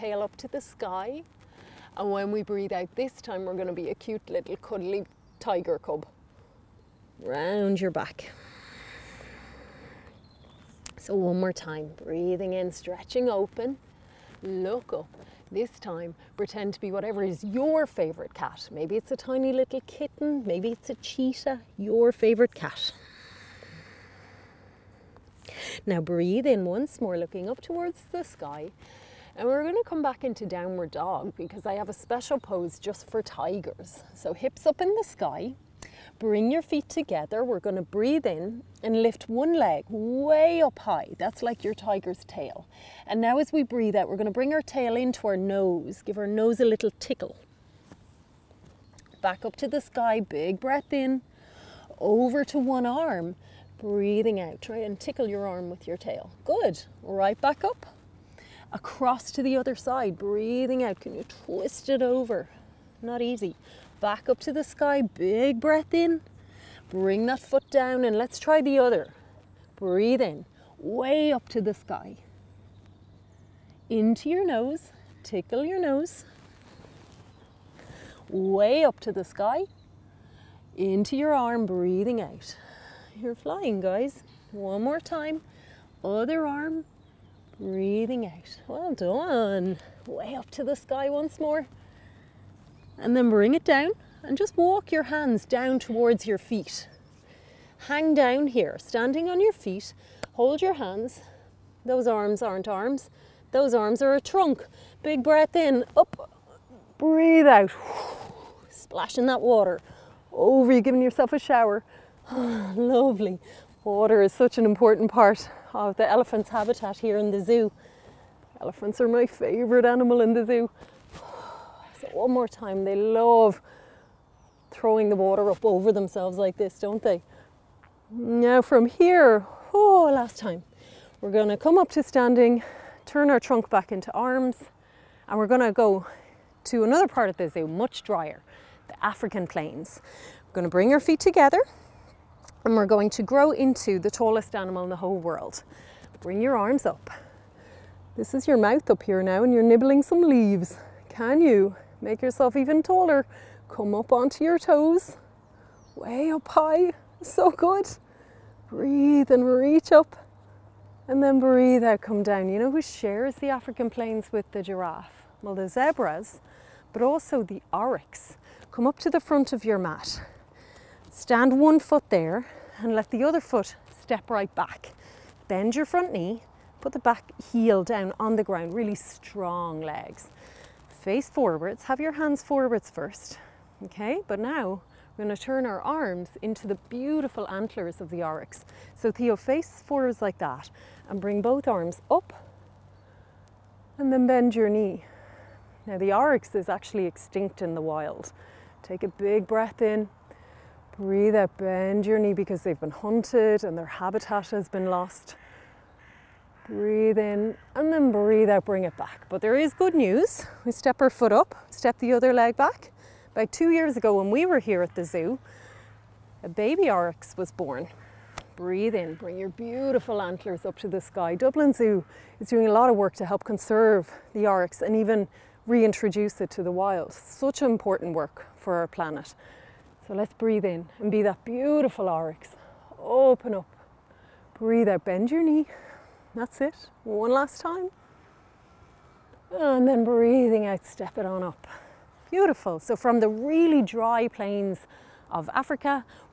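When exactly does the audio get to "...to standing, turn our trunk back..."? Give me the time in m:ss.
2:11.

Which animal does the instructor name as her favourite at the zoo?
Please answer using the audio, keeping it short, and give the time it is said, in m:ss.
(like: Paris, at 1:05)
Elephants, at 1:58.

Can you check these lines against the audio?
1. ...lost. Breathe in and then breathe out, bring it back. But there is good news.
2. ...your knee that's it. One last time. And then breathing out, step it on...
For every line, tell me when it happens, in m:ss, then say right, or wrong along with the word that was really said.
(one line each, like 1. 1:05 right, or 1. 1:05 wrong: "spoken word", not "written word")
1. 3:24 right
2. 3:55 right.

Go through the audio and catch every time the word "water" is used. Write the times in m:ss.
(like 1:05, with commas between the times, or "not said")
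1:49, 1:53, 2:05.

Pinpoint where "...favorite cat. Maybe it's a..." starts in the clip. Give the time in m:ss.
0:17.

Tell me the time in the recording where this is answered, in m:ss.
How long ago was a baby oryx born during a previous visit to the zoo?
3:33.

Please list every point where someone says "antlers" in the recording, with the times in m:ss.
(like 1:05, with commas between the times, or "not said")
3:07, 3:40.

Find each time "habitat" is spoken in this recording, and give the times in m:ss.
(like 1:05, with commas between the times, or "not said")
1:56, 3:23.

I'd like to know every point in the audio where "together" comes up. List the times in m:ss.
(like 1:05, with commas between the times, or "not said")
0:36, 2:21.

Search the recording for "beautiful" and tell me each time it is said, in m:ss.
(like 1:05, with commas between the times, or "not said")
3:06, 3:39, 3:51, 4:02.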